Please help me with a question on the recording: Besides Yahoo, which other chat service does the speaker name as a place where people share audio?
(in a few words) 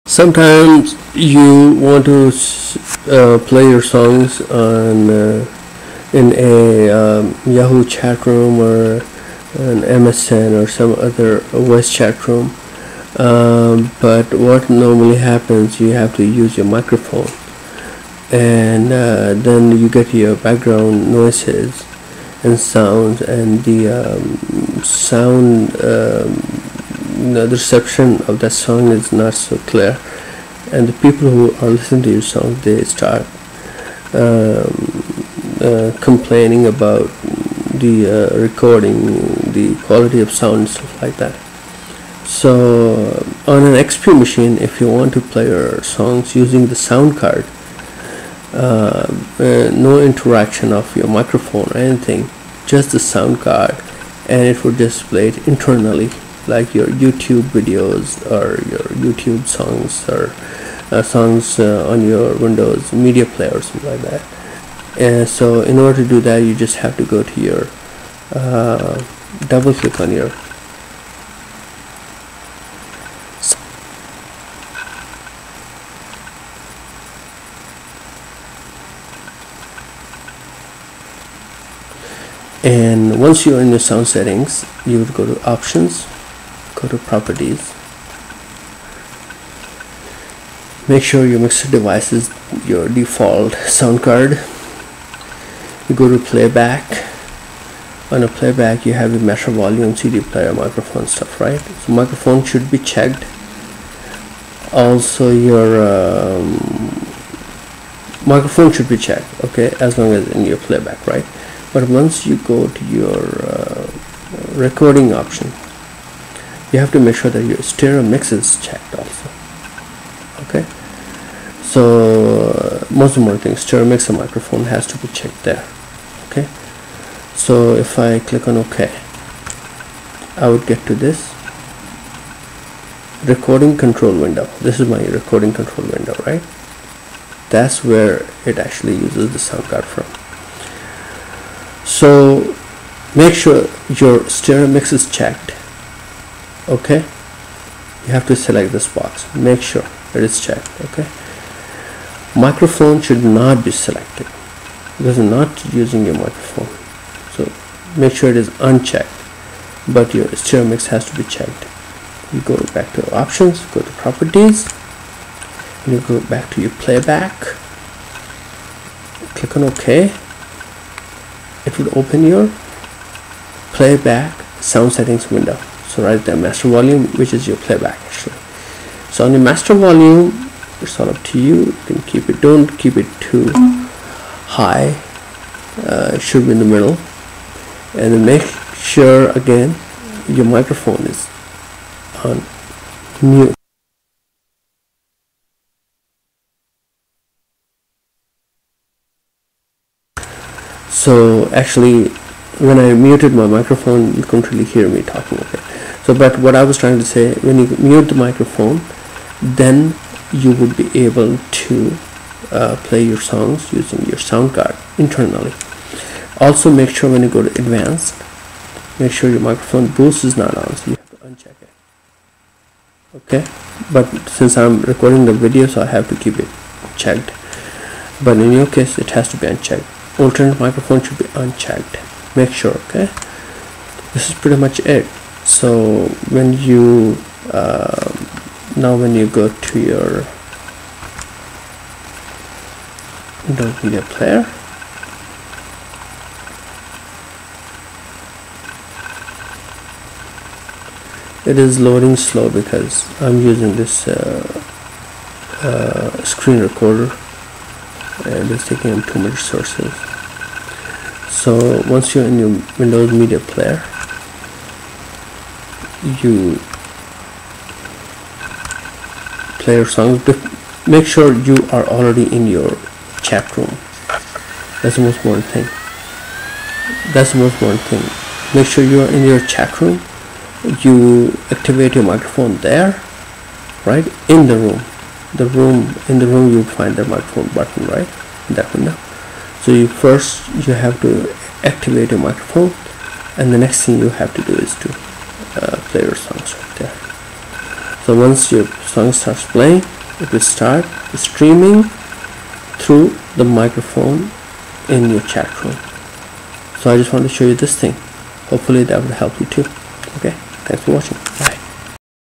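MSN.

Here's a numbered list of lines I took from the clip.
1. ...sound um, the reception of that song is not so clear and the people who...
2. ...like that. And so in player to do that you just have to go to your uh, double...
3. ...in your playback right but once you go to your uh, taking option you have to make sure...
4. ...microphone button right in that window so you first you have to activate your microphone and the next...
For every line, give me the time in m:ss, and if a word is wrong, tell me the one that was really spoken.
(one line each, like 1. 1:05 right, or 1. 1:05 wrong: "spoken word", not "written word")
1. 0:24 right
2. 1:03 wrong: "order", not "player"
3. 1:50 wrong: "recording", not "taking"
4. 4:47 right.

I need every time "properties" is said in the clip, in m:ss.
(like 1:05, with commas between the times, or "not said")
1:26, 2:44.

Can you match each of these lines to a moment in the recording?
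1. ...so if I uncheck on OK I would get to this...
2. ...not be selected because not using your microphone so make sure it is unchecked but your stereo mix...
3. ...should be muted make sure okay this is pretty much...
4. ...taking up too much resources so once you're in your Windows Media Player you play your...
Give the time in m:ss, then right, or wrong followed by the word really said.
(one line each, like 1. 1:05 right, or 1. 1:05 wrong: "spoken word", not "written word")
1. 2:07 wrong: "click", not "uncheck"
2. 2:33 right
3. 3:51 wrong: "unchecked", not "muted"
4. 4:18 right.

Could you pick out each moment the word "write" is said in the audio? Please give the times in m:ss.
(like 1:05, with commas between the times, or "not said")
2:56.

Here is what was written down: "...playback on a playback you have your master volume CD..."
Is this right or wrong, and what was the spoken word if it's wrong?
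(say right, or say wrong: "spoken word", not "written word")
right.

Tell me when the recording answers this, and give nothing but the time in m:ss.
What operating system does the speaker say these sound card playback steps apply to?
0:43.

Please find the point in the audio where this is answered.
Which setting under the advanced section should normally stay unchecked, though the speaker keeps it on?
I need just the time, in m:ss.
3:39.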